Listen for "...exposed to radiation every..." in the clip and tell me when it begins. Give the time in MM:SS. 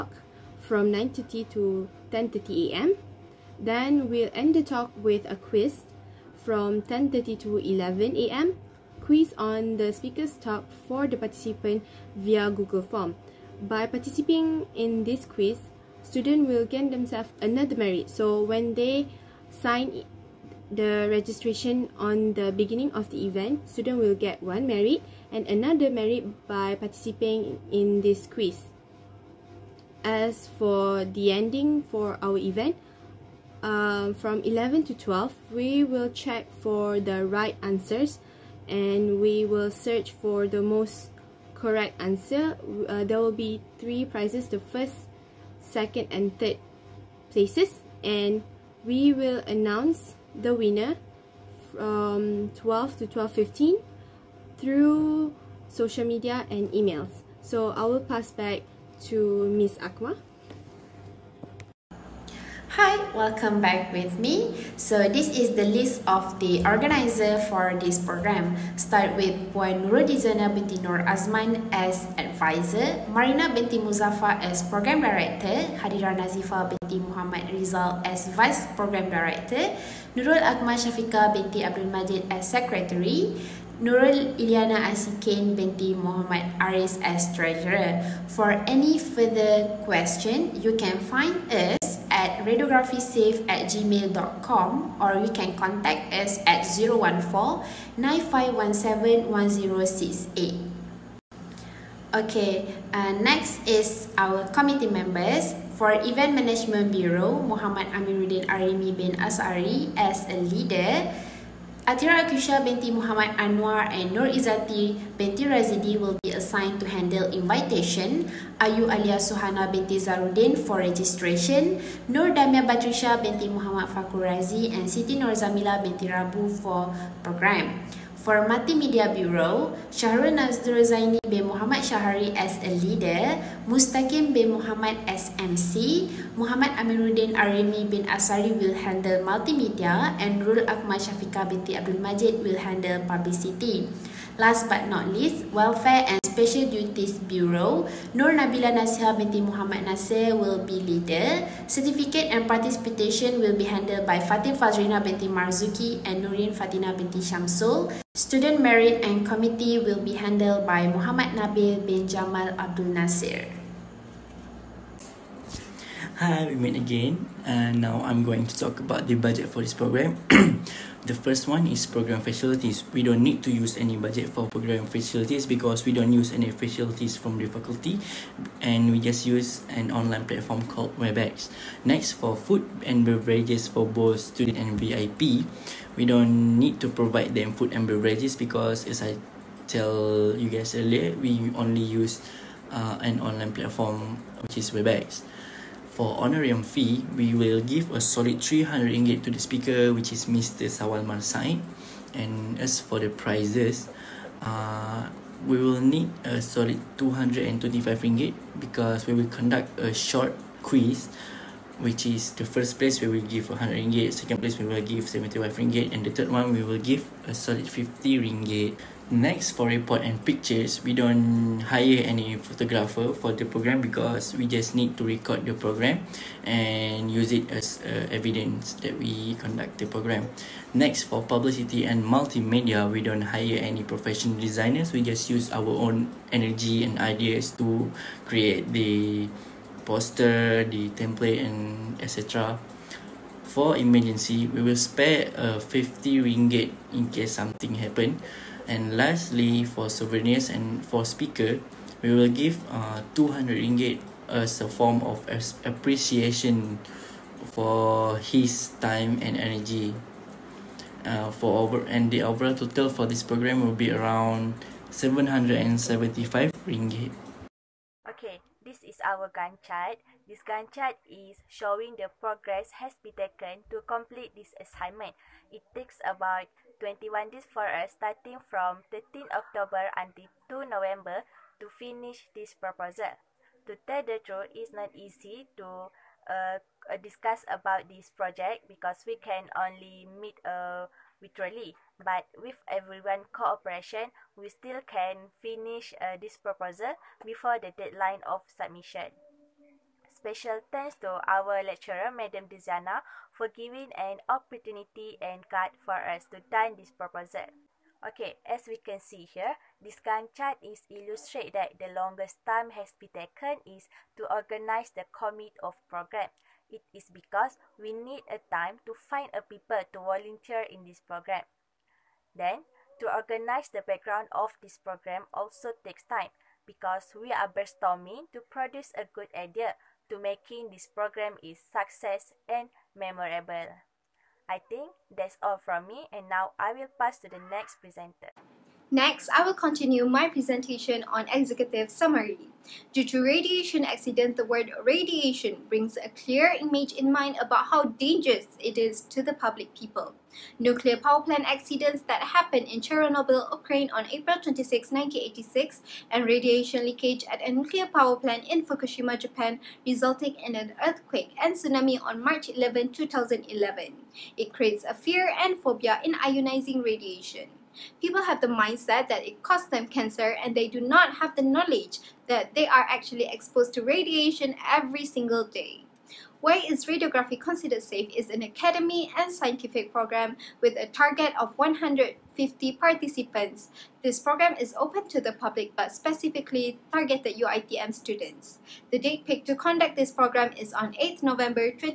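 06:13.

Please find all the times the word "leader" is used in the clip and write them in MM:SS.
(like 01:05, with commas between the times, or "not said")
01:50, 02:12, 02:30.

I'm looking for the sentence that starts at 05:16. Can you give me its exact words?
It is because we need a time to find a people to volunteer in this program.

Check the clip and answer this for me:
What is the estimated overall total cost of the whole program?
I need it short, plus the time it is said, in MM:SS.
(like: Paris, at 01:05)
775 ringgit, at 04:24.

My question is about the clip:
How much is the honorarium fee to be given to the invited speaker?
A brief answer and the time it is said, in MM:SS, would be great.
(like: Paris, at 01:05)
RM300, at 03:18.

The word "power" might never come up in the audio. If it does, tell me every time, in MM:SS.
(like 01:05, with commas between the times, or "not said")
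05:50, 05:57.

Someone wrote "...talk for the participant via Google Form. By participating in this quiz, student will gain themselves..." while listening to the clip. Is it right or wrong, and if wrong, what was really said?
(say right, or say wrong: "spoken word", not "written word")
right.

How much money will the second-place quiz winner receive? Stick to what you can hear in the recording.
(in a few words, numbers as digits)
75 ringgit.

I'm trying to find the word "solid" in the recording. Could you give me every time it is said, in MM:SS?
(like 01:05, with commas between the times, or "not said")
03:17, 03:26, 03:37.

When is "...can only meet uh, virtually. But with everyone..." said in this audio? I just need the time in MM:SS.
04:49.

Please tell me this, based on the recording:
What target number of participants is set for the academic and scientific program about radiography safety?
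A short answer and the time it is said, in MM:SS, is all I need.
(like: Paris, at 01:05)
150, at 06:21.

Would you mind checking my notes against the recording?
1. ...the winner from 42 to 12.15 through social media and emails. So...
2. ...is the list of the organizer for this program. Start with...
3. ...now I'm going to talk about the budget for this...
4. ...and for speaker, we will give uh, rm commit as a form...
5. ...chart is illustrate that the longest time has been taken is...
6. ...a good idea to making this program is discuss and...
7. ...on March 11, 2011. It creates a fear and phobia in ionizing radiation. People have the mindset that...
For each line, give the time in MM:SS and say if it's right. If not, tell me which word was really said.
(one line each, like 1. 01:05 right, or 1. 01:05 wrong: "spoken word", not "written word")
1. 00:50 wrong: "12", not "42"
2. 01:05 right
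3. 02:47 right
4. 04:10 wrong: "ringgit", not "commit"
5. 05:10 right
6. 05:28 wrong: "success", not "discuss"
7. 06:02 right.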